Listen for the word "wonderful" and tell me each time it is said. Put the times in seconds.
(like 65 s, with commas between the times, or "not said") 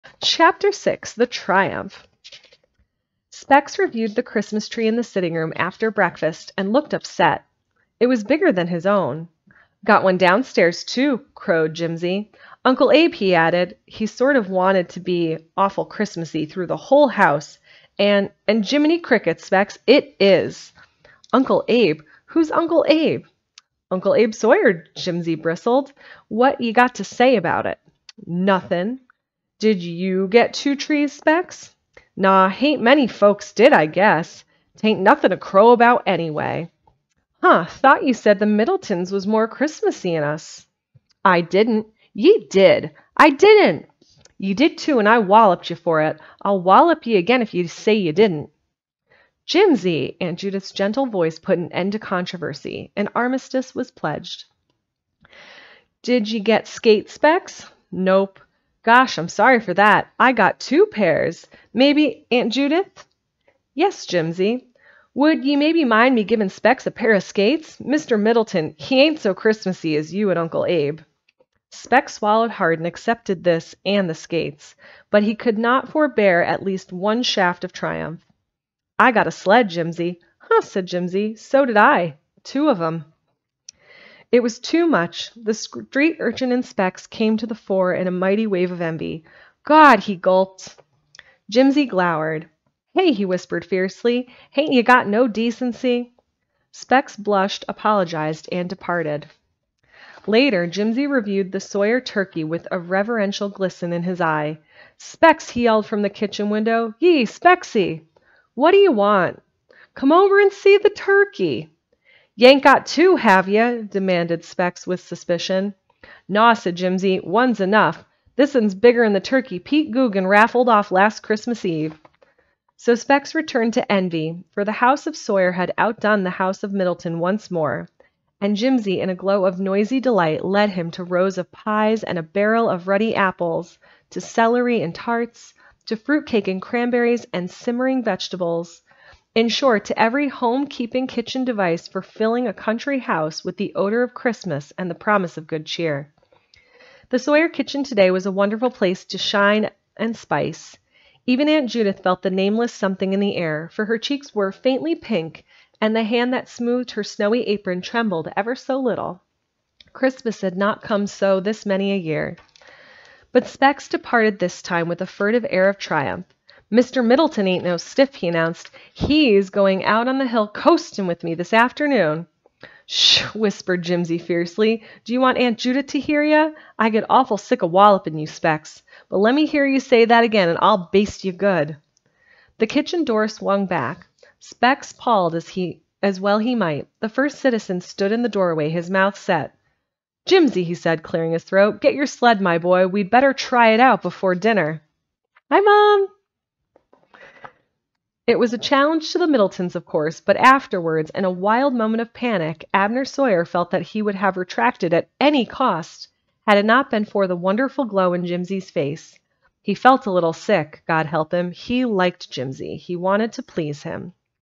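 148 s, 207 s.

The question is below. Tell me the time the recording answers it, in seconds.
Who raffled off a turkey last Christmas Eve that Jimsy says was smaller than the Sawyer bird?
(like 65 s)
119 s.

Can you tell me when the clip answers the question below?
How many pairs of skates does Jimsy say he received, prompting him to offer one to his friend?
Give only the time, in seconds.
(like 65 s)
60 s.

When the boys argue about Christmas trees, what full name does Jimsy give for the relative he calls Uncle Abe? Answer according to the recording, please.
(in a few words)
Abe Sawyer.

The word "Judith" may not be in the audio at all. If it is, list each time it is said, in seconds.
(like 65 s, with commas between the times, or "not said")
50 s, 62 s, 151 s, 175 s.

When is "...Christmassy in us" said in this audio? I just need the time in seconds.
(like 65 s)
39 s.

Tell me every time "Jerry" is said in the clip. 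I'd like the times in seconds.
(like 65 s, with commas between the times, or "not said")
not said.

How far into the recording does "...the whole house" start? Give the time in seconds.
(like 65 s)
16 s.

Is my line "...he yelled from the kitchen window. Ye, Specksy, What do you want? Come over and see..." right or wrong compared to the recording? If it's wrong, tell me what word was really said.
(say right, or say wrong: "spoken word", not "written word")
right.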